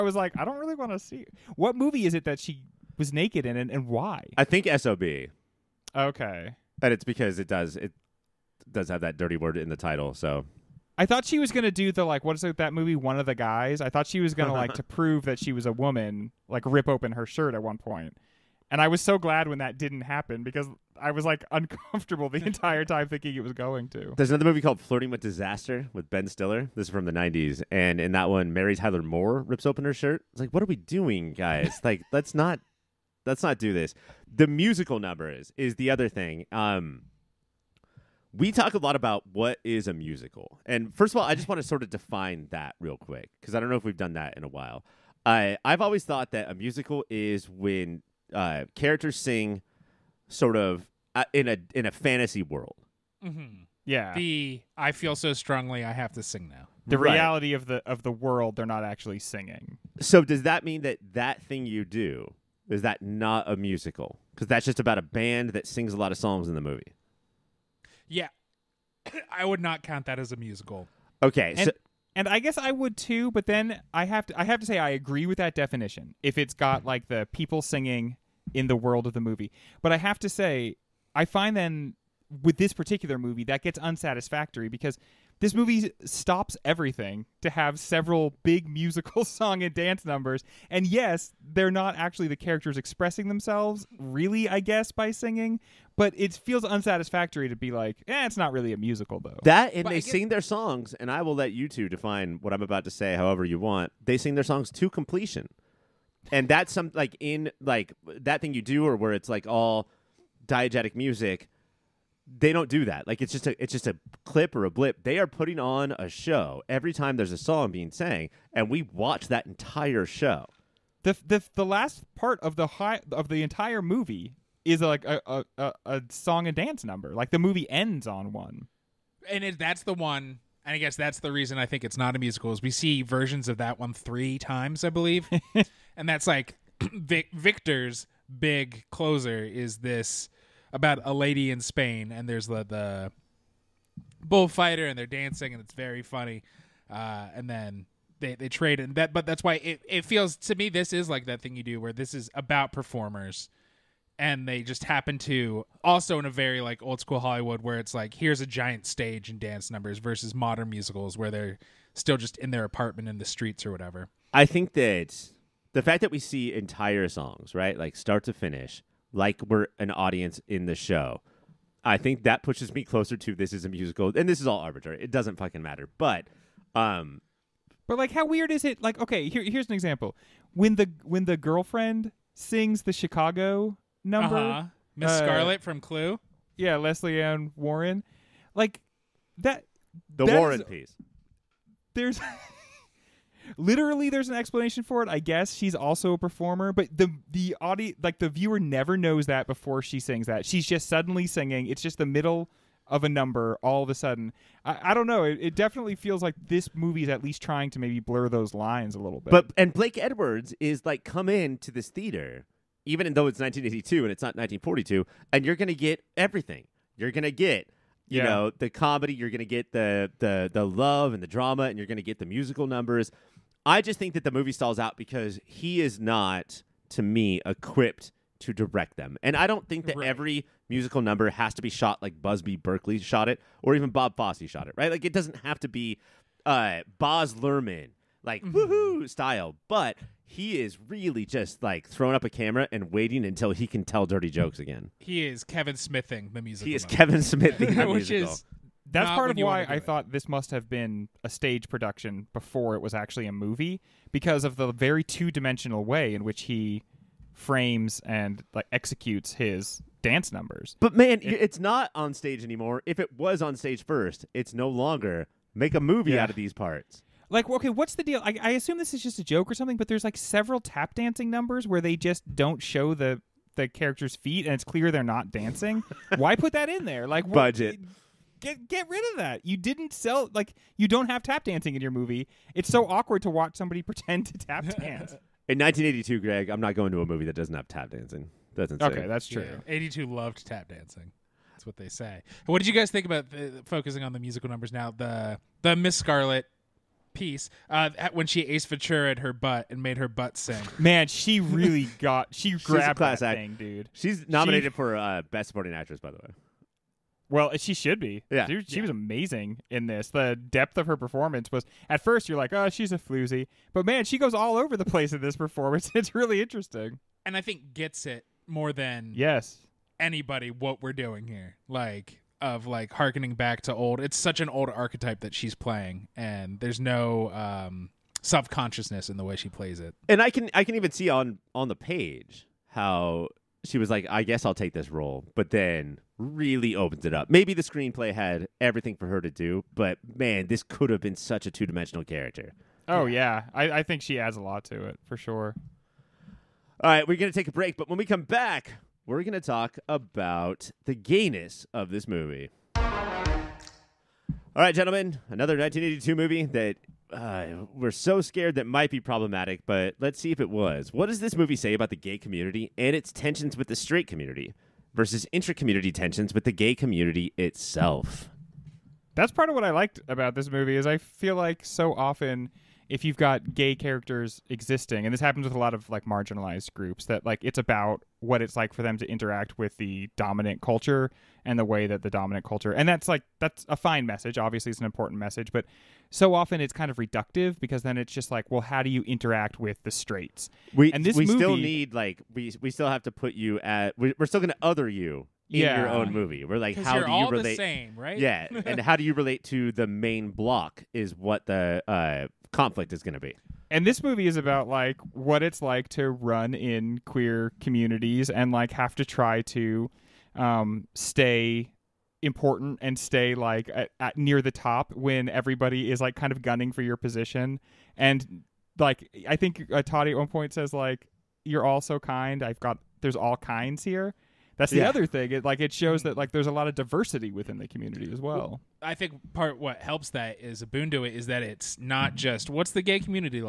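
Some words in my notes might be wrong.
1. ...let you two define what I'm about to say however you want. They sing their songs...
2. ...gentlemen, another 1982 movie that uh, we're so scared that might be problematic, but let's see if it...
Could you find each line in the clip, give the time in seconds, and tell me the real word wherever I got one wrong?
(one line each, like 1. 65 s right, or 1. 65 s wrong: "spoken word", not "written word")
1. 101 s right
2. 354 s right.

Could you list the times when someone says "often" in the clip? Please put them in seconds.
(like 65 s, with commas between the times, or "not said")
371 s, 386 s.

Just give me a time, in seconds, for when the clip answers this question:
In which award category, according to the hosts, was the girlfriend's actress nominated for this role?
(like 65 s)
305 s.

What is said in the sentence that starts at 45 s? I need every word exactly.
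I I've always thought that a musical is when uh, characters sing sort of uh, in a in a fantasy world.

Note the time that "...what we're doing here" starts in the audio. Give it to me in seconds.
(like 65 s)
320 s.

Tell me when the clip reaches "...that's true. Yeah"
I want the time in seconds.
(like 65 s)
289 s.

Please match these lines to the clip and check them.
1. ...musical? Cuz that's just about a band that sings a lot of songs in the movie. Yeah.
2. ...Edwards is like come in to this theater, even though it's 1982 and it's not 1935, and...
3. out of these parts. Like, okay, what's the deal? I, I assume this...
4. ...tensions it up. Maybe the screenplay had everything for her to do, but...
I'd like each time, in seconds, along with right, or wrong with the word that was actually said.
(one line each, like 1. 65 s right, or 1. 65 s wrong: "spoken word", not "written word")
1. 63 s right
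2. 209 s wrong: "1942", not "1935"
3. 266 s right
4. 336 s wrong: "opens", not "tensions".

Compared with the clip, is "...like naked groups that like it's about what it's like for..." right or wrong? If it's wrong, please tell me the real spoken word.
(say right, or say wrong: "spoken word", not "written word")
wrong: "marginalized", not "naked".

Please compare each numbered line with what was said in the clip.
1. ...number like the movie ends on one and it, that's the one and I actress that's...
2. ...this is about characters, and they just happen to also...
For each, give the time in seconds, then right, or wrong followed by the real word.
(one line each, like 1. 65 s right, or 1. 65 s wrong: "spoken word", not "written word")
1. 126 s wrong: "guess", not "actress"
2. 151 s wrong: "performers", not "characters".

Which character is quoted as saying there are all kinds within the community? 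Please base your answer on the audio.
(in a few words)
Toddy.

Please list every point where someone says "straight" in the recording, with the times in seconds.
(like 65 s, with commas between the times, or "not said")
363 s, 389 s.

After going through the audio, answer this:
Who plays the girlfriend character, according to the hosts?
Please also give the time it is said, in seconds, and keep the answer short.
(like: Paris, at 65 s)
Lesley Ann Warren, at 186 s.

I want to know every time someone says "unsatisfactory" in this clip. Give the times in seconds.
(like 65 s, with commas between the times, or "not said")
83 s, 96 s.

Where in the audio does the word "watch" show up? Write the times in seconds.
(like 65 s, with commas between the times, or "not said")
118 s, 283 s.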